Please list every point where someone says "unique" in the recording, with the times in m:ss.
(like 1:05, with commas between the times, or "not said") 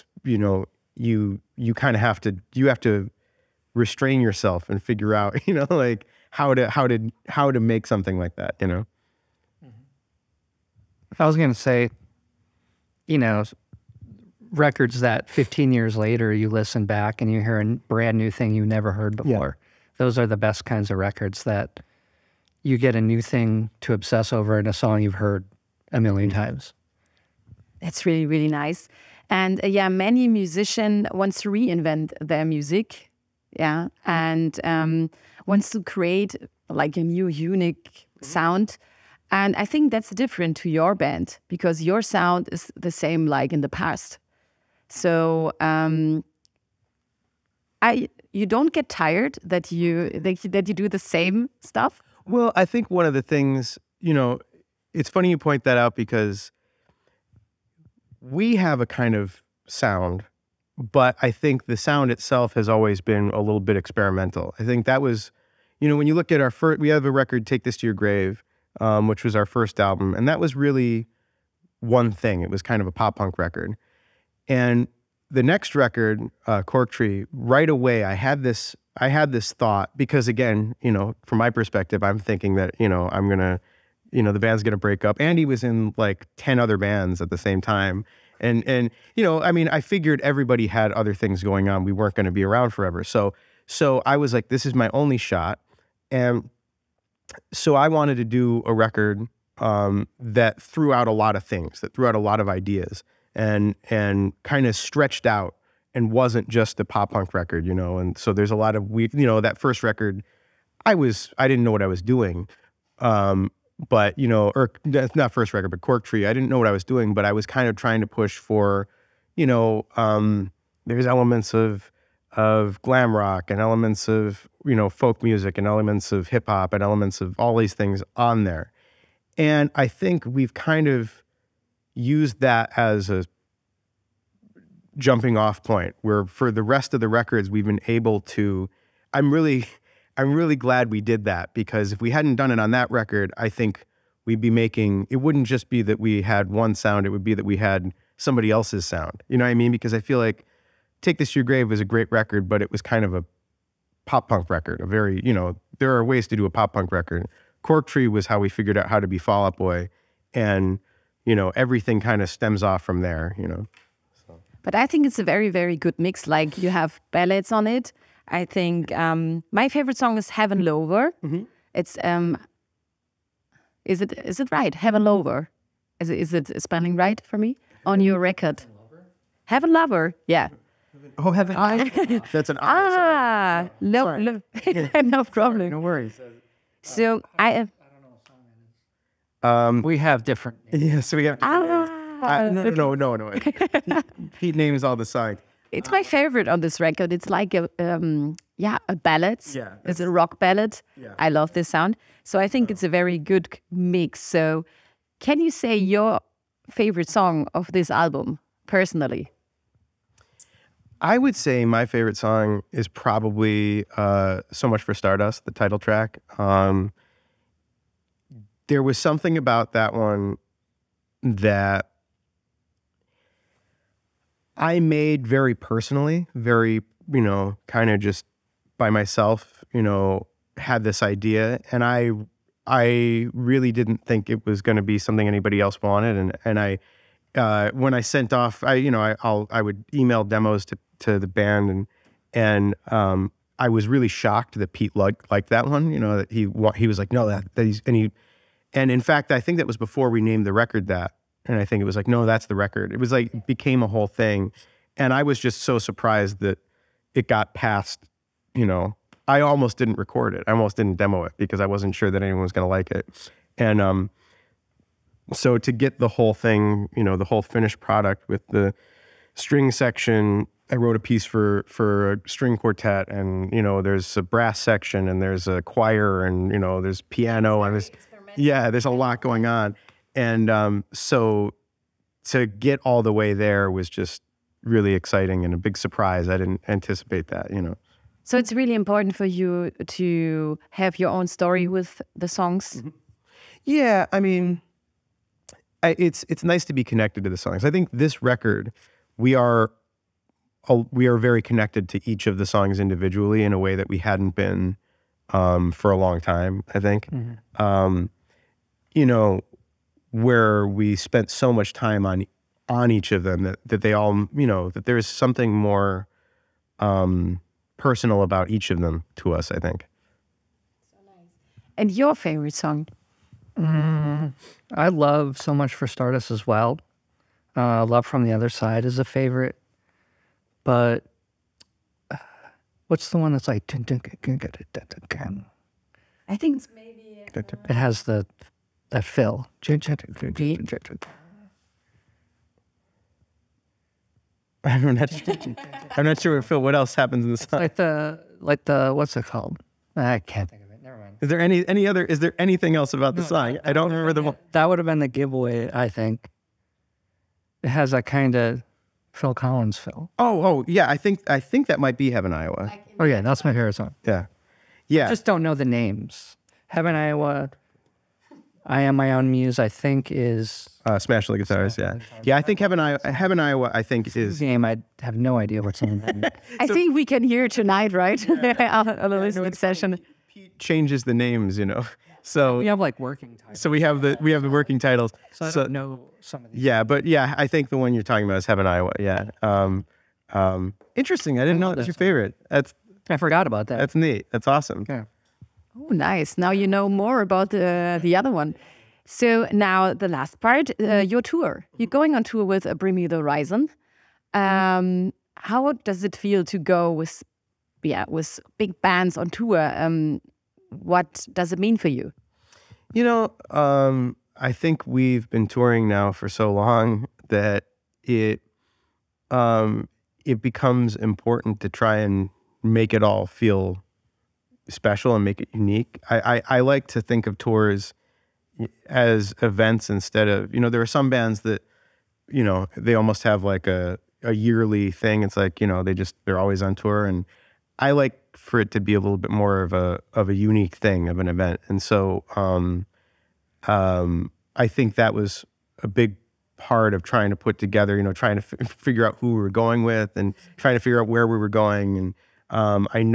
0:37, 7:05, 7:20.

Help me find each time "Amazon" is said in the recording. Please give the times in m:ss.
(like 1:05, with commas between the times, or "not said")
not said.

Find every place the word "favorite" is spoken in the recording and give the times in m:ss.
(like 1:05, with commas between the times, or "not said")
2:49, 3:16, 3:26, 3:31, 5:22, 5:29, 6:03, 6:31.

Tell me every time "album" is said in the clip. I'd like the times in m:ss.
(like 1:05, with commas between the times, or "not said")
1:09, 3:27.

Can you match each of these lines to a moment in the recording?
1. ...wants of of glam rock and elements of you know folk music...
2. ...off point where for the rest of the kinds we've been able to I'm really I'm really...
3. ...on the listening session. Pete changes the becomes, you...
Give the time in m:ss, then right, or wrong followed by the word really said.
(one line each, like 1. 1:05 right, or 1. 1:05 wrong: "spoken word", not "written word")
1. 2:01 wrong: "elements", not "wants"
2. 2:15 wrong: "records", not "kinds"
3. 6:19 wrong: "names", not "becomes".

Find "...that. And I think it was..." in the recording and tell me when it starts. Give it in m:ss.
4:10.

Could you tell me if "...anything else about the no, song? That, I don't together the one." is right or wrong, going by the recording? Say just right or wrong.
wrong.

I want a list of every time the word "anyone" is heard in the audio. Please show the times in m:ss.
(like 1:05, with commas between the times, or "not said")
4:22.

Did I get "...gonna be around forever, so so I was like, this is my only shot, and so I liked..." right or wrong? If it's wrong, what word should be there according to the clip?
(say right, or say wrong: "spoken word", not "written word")
wrong: "wanted", not "liked".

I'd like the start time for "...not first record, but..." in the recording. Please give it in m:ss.
1:54.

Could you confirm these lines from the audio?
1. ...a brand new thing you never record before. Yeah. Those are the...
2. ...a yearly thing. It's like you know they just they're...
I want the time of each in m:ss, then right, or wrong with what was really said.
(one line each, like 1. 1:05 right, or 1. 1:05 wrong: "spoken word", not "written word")
1. 0:17 wrong: "heard", not "record"
2. 7:14 right.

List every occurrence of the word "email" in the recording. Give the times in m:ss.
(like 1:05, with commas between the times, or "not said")
3:59.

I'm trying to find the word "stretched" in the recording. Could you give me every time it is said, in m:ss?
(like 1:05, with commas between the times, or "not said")
1:44.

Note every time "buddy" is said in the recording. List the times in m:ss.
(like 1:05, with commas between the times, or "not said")
not said.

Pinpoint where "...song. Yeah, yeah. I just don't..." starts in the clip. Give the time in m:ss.
6:03.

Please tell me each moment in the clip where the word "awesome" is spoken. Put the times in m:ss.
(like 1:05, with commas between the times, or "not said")
6:34.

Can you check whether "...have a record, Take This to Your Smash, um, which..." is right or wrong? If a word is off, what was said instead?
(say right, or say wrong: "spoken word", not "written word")
wrong: "Grave", not "Smash".